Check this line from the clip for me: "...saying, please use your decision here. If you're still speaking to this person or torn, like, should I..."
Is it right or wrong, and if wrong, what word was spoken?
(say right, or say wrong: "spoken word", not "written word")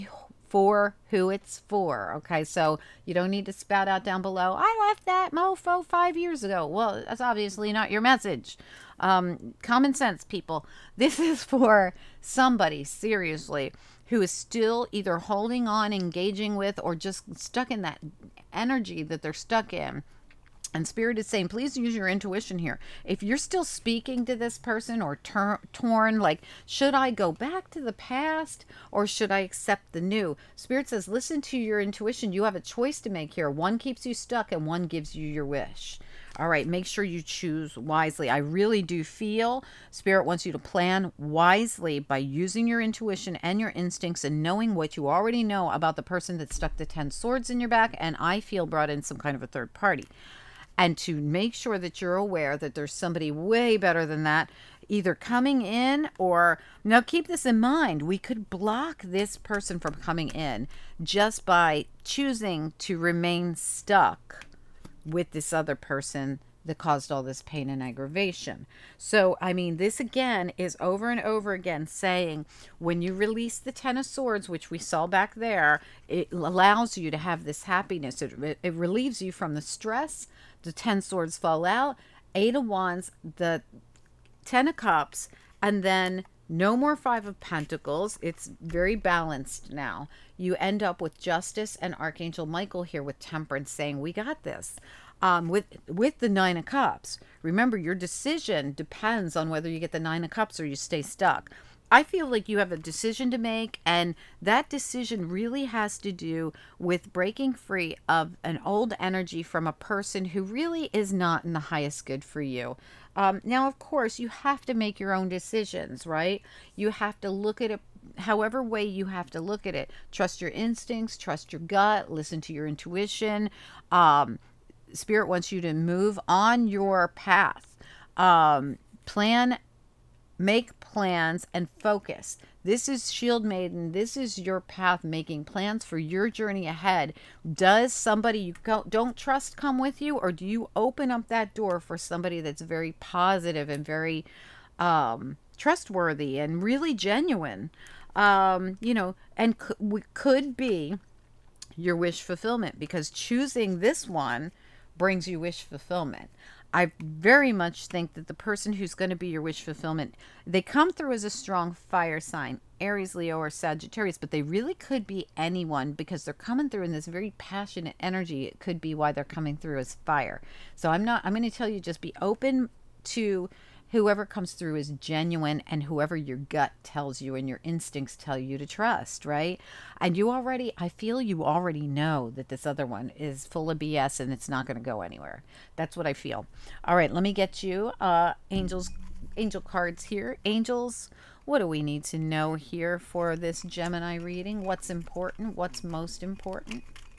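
wrong: "intuition", not "decision".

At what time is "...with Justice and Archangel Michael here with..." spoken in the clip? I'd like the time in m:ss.
1:30.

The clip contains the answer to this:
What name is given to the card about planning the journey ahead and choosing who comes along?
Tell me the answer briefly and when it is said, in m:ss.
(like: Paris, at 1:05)
Shield Maiden, at 2:13.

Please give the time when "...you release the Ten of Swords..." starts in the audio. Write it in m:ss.
1:13.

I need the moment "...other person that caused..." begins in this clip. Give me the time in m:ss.
1:05.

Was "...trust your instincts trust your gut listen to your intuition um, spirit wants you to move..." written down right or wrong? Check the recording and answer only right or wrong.
right.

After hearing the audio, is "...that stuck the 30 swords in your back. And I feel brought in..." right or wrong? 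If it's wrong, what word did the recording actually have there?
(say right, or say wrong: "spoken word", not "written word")
wrong: "10", not "30".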